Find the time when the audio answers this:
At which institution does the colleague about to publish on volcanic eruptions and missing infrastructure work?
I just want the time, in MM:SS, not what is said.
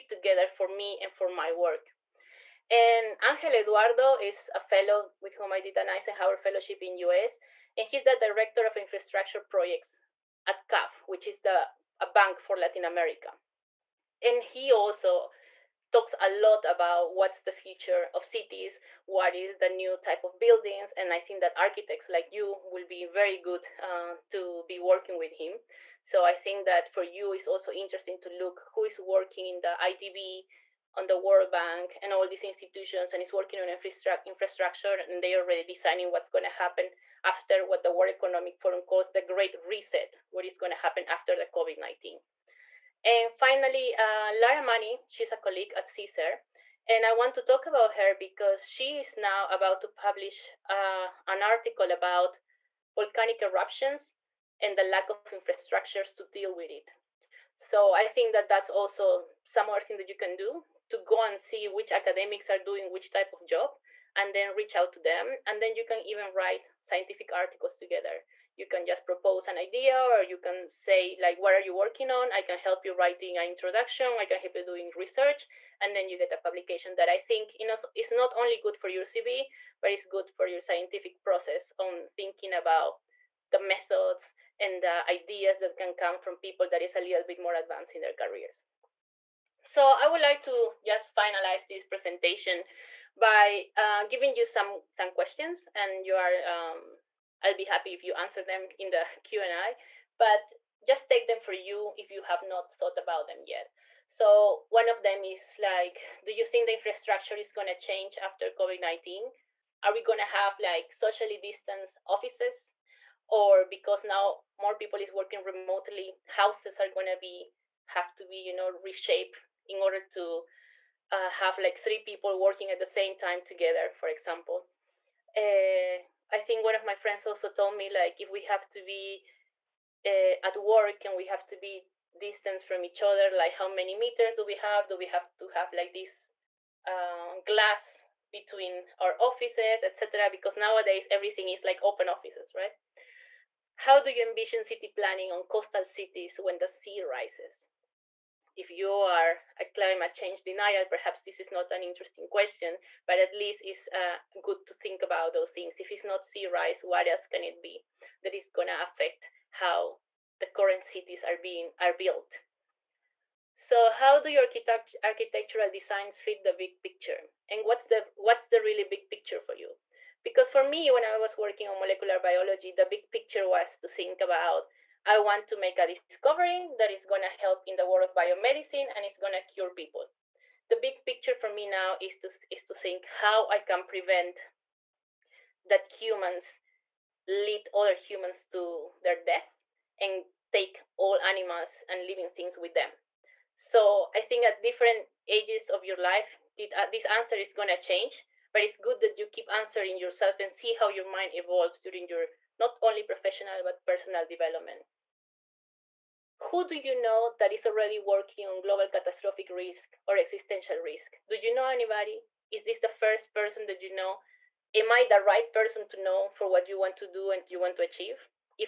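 00:45.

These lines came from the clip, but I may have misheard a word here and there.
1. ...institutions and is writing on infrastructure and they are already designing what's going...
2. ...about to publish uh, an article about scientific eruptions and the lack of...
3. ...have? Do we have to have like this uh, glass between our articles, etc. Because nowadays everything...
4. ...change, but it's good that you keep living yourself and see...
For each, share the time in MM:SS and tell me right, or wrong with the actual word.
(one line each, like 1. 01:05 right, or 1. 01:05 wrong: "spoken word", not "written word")
1. 00:32 wrong: "working", not "writing"
2. 00:49 wrong: "volcanic", not "scientific"
3. 02:14 wrong: "offices", not "articles"
4. 03:17 wrong: "answering", not "living".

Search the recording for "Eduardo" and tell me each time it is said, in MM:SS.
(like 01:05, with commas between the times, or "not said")
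00:03.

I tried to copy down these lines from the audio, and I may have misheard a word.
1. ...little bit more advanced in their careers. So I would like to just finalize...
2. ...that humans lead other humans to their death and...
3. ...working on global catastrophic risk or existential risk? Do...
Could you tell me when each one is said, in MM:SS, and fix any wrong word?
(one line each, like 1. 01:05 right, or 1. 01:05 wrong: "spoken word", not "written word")
1. 01:26 right
2. 03:05 right
3. 03:27 right.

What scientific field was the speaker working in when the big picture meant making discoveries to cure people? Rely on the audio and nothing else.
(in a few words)
molecular biology.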